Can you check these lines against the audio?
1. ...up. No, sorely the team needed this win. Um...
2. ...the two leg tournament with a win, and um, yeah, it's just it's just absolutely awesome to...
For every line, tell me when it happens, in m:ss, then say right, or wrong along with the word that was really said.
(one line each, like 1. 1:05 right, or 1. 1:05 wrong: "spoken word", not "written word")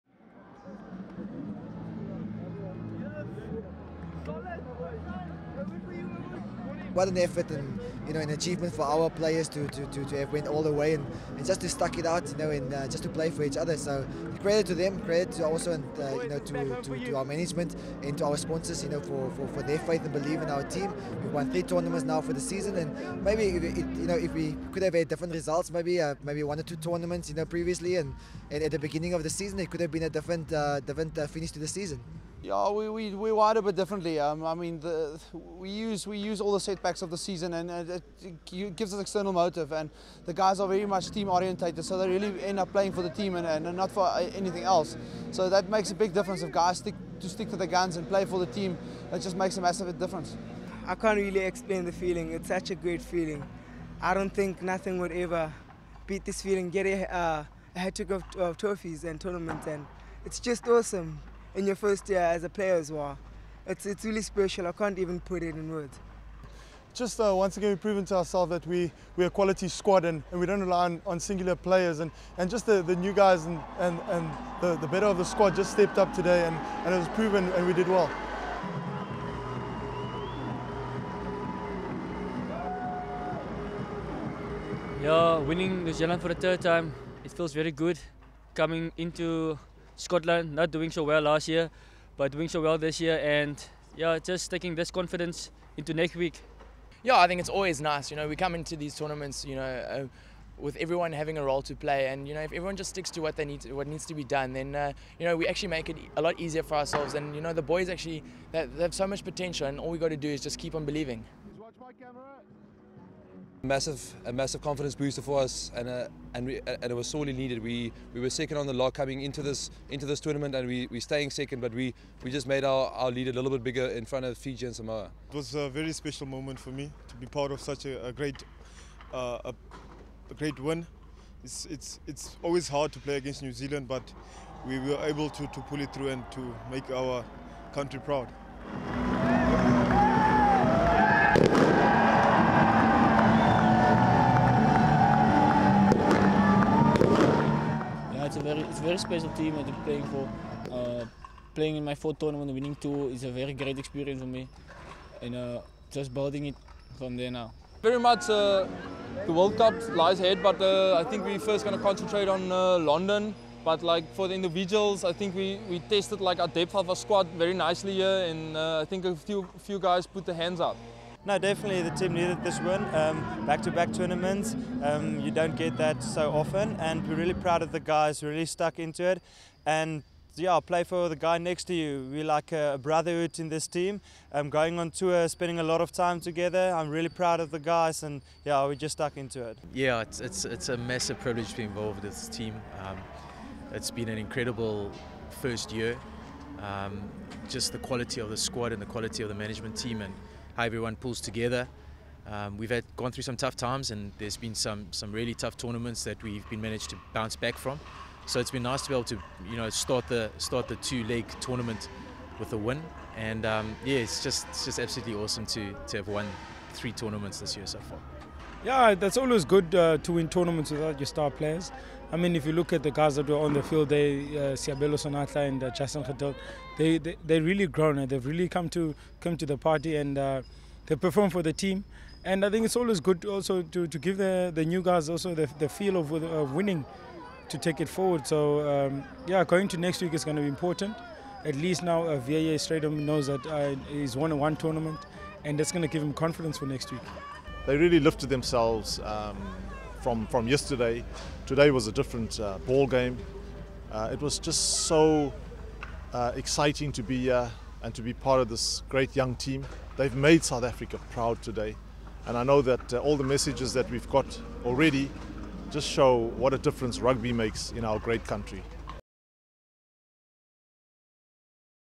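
1. 2:50 wrong: "definitely", not "sorely"
2. 3:30 right.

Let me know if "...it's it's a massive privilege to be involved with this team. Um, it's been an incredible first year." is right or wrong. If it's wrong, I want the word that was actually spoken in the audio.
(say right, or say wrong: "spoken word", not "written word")
right.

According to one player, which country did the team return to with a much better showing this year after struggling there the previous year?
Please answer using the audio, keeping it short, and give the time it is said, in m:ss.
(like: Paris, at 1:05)
Scotland, at 1:30.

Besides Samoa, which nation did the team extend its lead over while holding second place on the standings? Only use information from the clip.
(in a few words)
Fiji.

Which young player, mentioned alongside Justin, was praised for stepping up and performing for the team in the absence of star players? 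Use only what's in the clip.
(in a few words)
Seabelo Senatla.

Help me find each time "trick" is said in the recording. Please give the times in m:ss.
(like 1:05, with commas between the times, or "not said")
0:57.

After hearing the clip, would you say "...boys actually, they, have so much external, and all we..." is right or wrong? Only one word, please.
wrong.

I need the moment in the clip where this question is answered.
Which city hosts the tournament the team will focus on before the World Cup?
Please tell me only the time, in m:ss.
2:42.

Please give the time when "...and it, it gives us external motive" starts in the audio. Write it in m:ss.
0:37.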